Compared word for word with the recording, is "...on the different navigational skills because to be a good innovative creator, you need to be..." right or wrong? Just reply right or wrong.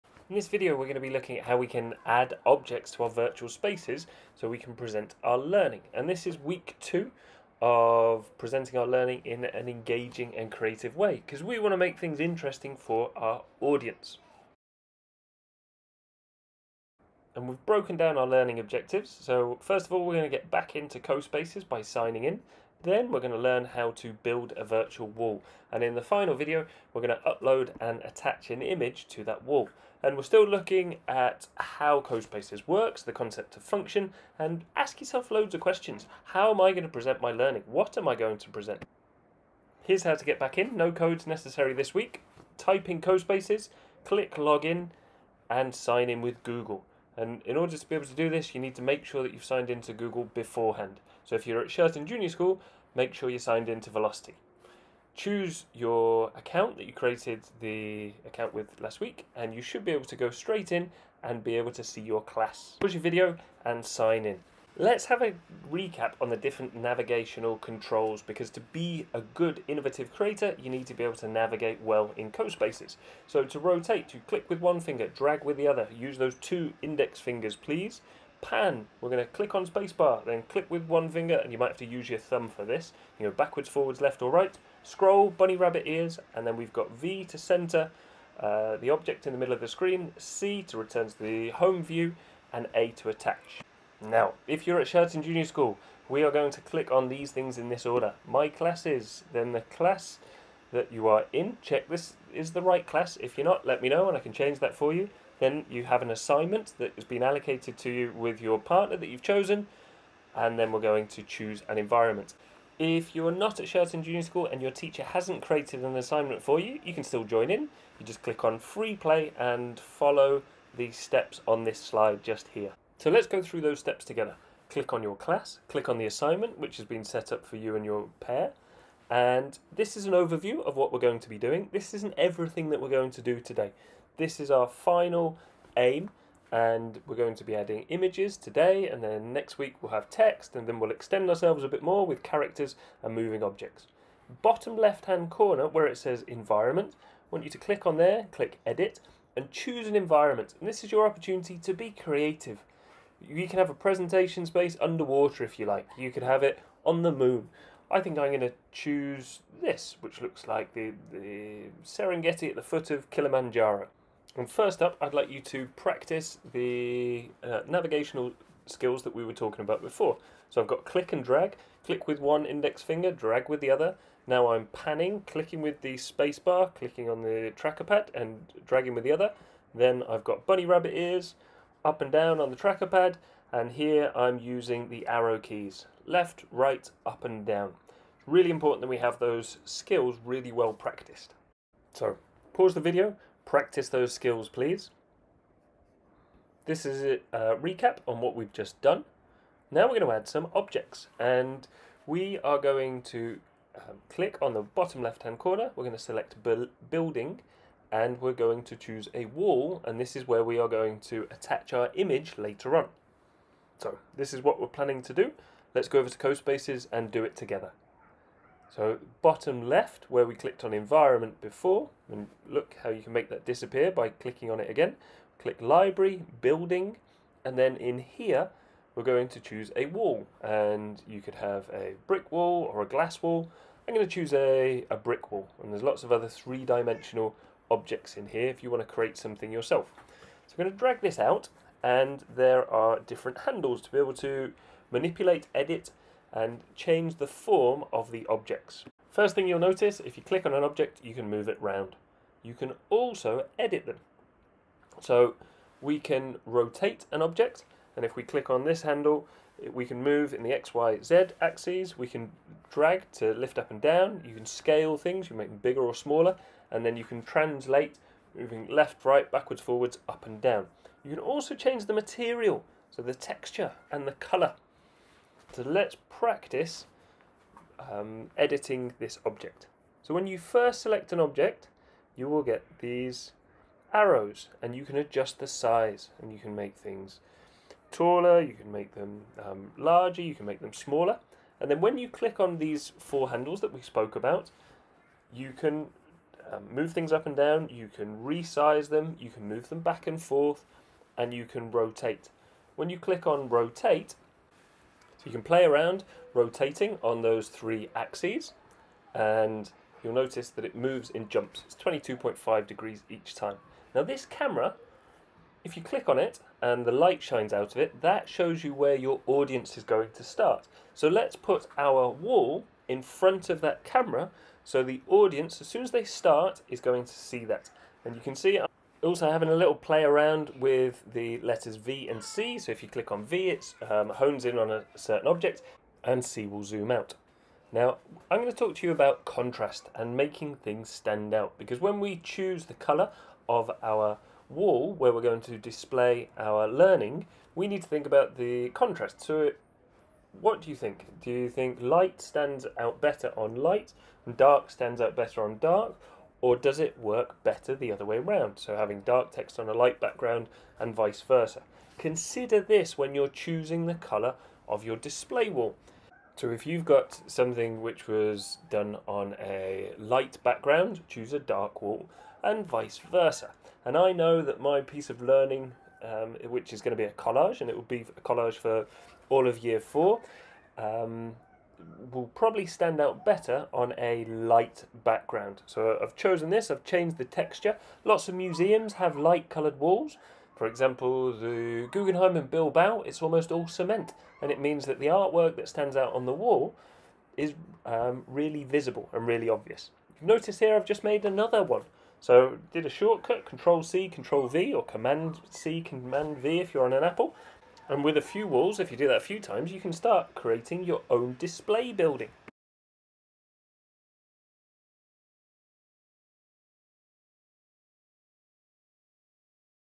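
wrong.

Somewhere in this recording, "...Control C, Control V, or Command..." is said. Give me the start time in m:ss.
6:43.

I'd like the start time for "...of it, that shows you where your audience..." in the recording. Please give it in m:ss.
5:17.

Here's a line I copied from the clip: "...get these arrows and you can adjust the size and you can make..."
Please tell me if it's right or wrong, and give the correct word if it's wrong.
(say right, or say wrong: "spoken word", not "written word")
right.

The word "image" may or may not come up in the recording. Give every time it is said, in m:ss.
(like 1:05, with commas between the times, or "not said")
0:28, 2:17, 3:31.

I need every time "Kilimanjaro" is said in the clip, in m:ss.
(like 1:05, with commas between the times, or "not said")
2:43.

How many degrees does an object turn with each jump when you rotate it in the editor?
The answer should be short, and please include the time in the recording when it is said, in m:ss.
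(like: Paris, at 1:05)
22.5 degrees, at 5:11.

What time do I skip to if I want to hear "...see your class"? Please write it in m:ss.
1:01.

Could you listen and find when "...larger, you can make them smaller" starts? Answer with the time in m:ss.
4:49.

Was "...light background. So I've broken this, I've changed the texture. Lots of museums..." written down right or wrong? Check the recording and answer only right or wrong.
wrong.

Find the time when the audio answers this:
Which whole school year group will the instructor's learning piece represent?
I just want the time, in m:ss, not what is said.
6:19.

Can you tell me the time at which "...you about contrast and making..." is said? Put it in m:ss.
5:38.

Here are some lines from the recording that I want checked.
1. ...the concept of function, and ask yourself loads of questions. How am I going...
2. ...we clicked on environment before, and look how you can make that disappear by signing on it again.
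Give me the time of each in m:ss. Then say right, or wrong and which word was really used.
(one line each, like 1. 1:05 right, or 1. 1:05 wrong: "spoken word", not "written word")
1. 0:33 right
2. 3:40 wrong: "clicking", not "signing".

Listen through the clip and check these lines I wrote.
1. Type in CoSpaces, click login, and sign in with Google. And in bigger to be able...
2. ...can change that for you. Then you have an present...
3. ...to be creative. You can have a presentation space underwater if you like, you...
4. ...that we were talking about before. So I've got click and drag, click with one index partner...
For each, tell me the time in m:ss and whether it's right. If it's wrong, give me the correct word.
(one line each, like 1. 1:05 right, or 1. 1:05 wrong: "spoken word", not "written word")
1. 0:42 wrong: "order", not "bigger"
2. 1:44 wrong: "assignment", not "present"
3. 2:31 right
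4. 2:49 wrong: "finger", not "partner".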